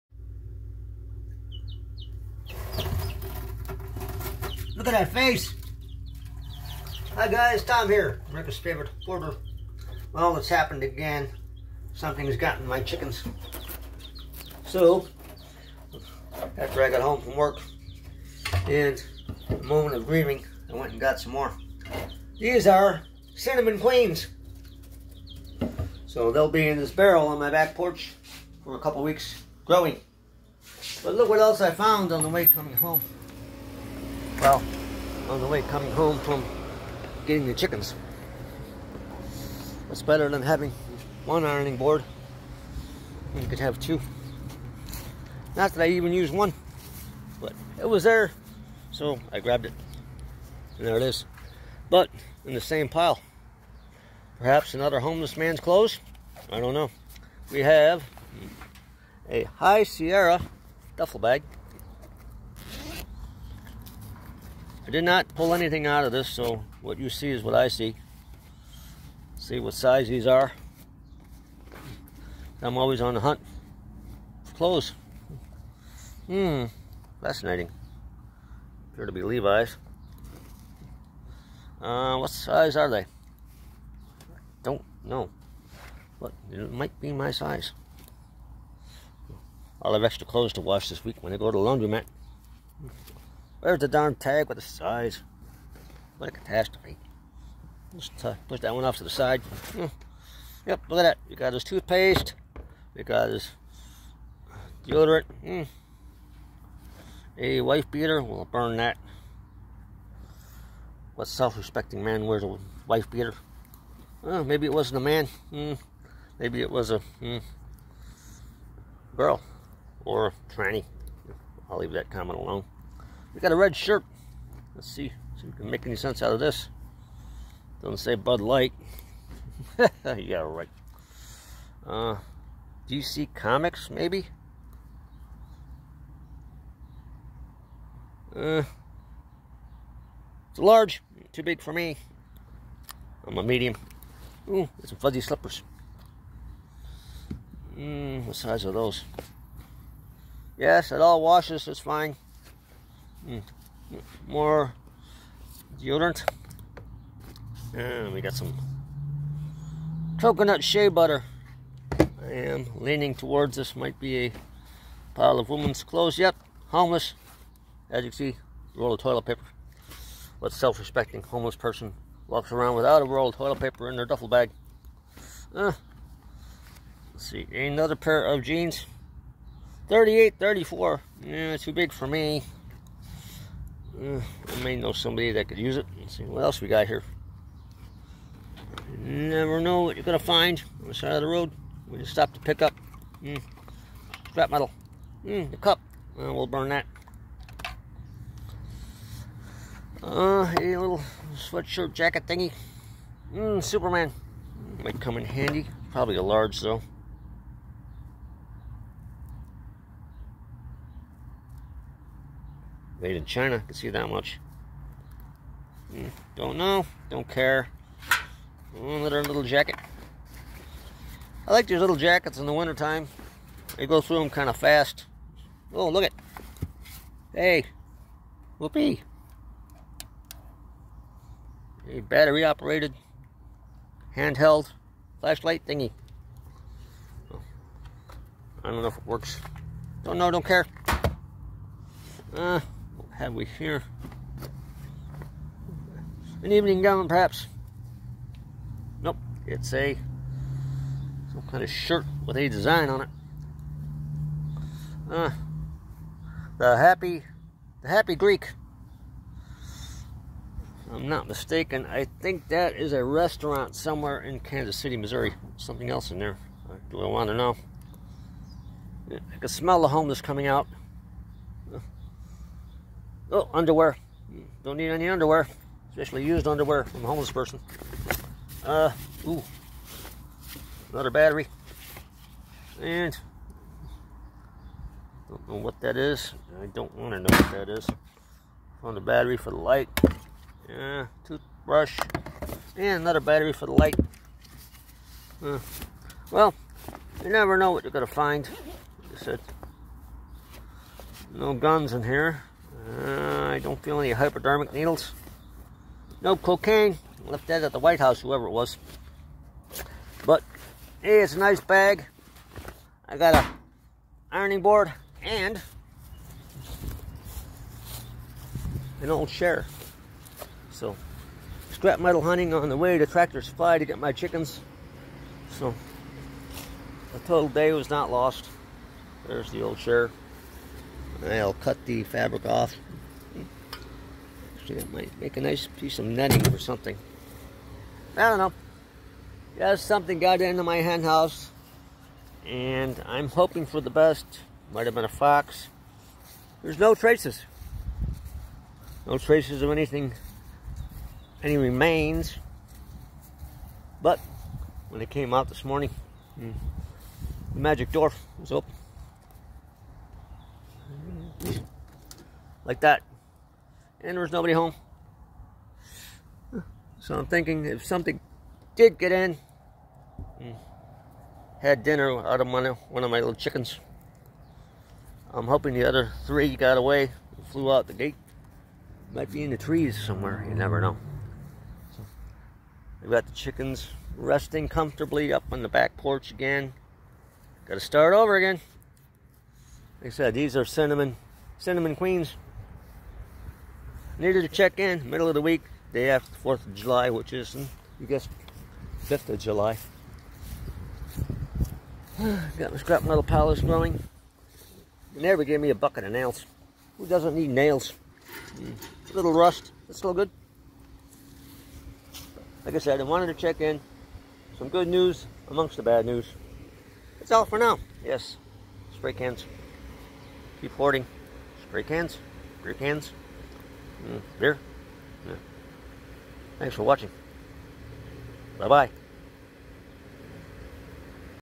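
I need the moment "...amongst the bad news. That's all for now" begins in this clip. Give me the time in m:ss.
6:55.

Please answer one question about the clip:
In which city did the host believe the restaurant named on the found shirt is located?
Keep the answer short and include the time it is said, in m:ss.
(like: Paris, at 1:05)
Kansas City, Missouri, at 4:24.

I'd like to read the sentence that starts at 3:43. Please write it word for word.
They go through them kind of fast.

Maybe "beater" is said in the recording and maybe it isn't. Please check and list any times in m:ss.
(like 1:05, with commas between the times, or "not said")
1:47, 1:53.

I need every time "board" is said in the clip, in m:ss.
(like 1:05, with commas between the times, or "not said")
0:41, 5:14.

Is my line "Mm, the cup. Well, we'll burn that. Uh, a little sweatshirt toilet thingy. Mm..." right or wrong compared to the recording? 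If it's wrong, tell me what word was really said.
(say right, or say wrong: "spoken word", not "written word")
wrong: "jacket", not "toilet".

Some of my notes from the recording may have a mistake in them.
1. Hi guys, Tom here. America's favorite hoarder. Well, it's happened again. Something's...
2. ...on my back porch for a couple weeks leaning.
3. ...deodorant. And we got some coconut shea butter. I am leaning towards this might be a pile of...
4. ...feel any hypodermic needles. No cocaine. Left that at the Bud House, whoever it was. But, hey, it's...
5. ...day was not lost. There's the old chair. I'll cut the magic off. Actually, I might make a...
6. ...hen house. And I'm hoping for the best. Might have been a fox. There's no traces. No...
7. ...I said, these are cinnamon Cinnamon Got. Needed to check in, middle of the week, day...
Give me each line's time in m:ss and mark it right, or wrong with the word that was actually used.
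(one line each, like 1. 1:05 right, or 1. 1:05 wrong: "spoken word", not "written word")
1. 0:07 right
2. 0:27 wrong: "growing", not "leaning"
3. 2:35 right
4. 5:03 wrong: "White", not "Bud"
5. 5:27 wrong: "fabric", not "magic"
6. 5:40 right
7. 6:30 wrong: "Queens", not "Got".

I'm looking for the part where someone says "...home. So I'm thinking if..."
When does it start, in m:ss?
6:04.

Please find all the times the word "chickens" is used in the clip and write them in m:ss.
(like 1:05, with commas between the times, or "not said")
0:12, 0:37, 5:24, 6:13, 6:23.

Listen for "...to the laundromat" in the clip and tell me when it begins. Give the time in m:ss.
1:31.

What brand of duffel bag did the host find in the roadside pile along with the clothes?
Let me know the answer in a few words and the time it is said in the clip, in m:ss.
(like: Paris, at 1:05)
High Sierra, at 0:59.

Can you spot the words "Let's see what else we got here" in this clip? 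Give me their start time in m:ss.
3:05.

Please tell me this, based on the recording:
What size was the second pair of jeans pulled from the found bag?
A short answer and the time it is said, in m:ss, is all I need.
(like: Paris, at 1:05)
38, 34, at 2:59.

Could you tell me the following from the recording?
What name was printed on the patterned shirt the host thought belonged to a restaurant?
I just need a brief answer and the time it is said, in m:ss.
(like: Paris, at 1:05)
The Happy Greek, at 4:17.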